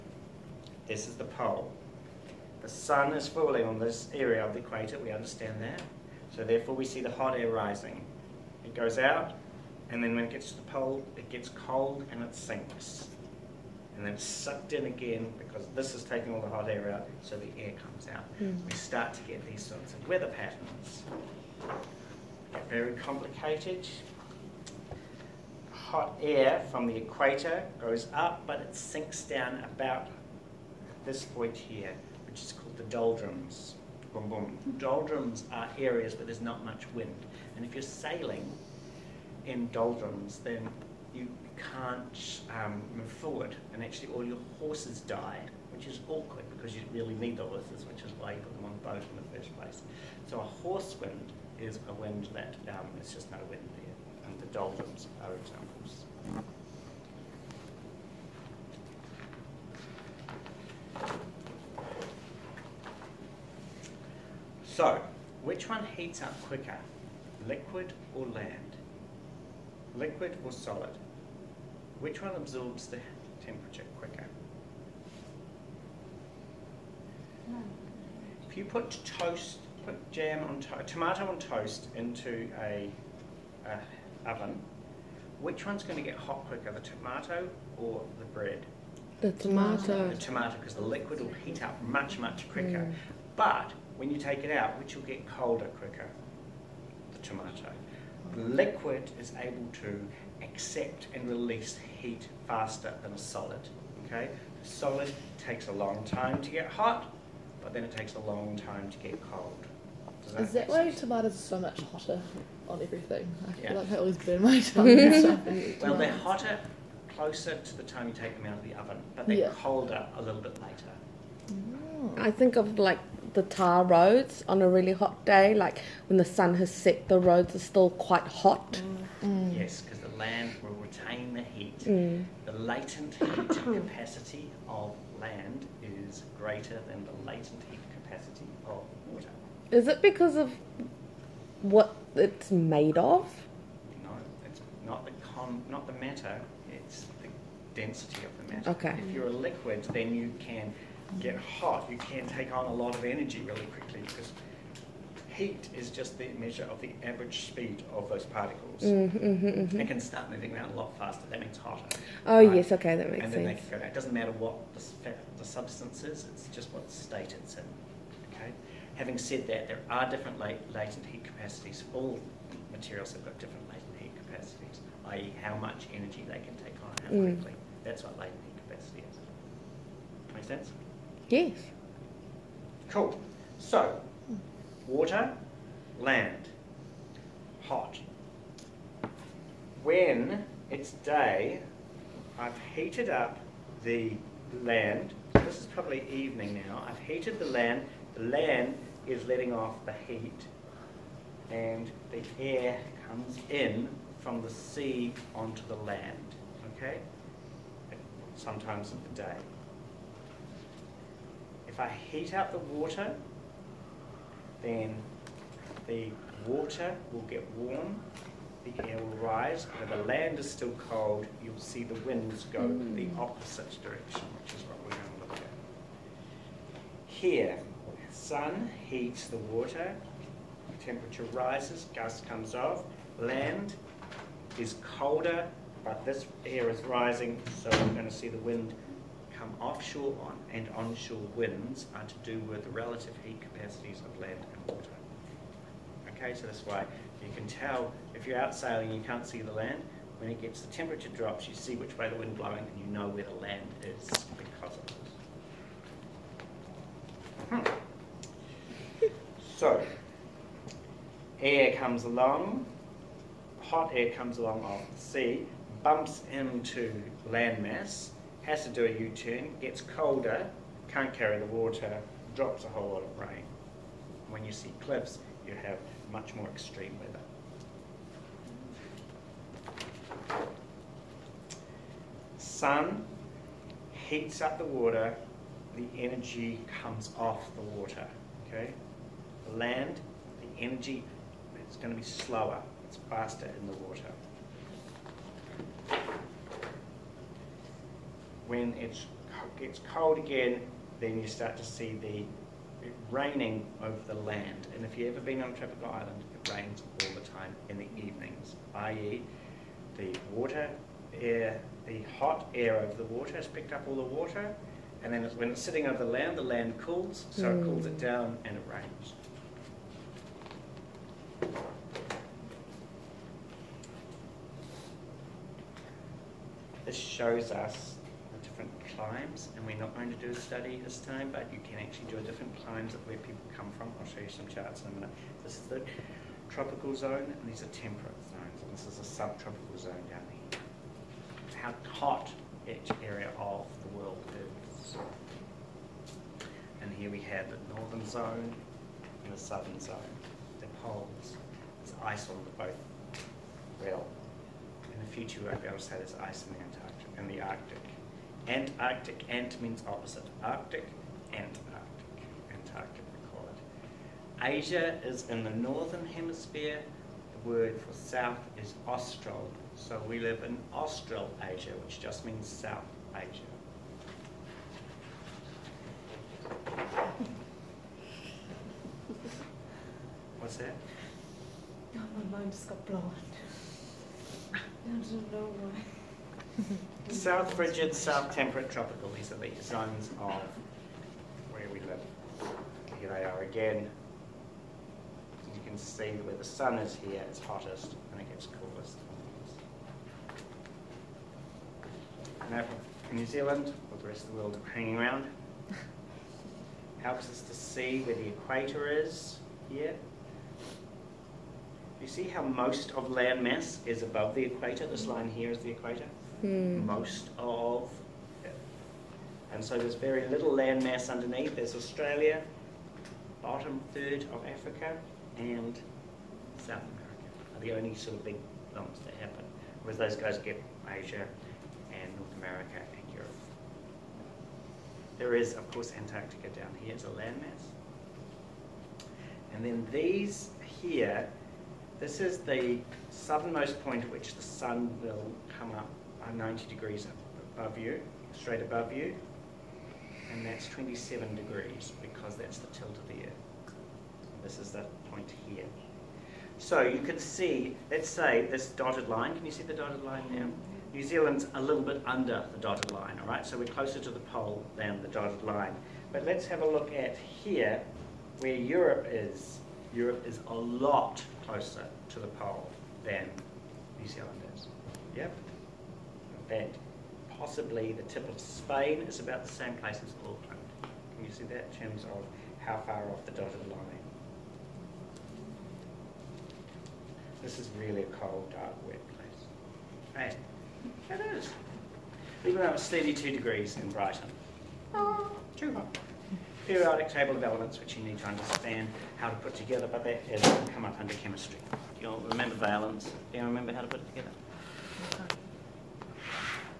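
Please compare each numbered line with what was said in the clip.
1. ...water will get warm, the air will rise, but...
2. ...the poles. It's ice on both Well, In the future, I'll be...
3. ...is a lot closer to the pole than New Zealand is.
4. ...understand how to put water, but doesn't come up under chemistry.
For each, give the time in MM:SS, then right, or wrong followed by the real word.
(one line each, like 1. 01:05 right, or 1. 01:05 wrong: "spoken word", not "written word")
1. 03:36 right
2. 05:50 right
3. 07:50 right
4. 08:18 wrong: "together", not "water".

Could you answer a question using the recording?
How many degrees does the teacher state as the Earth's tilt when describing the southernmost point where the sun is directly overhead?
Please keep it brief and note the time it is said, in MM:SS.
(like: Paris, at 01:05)
27, at 07:30.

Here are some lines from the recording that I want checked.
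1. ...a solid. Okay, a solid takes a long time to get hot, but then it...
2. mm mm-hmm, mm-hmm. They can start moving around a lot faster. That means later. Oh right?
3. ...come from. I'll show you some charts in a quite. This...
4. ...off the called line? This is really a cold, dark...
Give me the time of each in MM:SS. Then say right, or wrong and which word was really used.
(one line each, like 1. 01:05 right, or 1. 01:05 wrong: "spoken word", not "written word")
1. 01:43 right
2. 02:38 wrong: "hotter", not "later"
3. 05:33 wrong: "minute", not "quite"
4. 08:03 wrong: "dotted", not "called".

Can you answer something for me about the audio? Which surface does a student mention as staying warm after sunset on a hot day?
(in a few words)
tar roads.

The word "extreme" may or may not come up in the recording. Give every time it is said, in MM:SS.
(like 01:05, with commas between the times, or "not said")
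04:36.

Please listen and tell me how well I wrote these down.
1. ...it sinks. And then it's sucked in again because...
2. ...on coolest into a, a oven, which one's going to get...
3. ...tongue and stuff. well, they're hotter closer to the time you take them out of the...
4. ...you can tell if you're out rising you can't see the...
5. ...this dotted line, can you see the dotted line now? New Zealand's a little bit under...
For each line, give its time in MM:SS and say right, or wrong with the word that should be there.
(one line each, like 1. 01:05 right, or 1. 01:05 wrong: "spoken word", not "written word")
1. 00:12 right
2. 01:21 wrong: "toast", not "coolest"
3. 01:54 right
4. 04:07 wrong: "sailing", not "rising"
5. 07:38 right.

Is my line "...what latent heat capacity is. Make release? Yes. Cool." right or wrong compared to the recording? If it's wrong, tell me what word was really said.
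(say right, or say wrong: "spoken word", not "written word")
wrong: "sense", not "release".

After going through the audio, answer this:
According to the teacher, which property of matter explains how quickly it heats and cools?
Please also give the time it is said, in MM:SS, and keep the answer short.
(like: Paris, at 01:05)
density, at 02:27.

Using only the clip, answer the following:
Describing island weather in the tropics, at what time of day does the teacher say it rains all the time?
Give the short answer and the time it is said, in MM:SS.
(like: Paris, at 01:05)
in the evenings, at 05:07.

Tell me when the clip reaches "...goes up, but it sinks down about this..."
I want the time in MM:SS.
00:27.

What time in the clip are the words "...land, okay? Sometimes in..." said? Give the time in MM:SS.
03:25.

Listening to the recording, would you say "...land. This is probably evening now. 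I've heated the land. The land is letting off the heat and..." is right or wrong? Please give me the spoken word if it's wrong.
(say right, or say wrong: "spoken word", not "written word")
right.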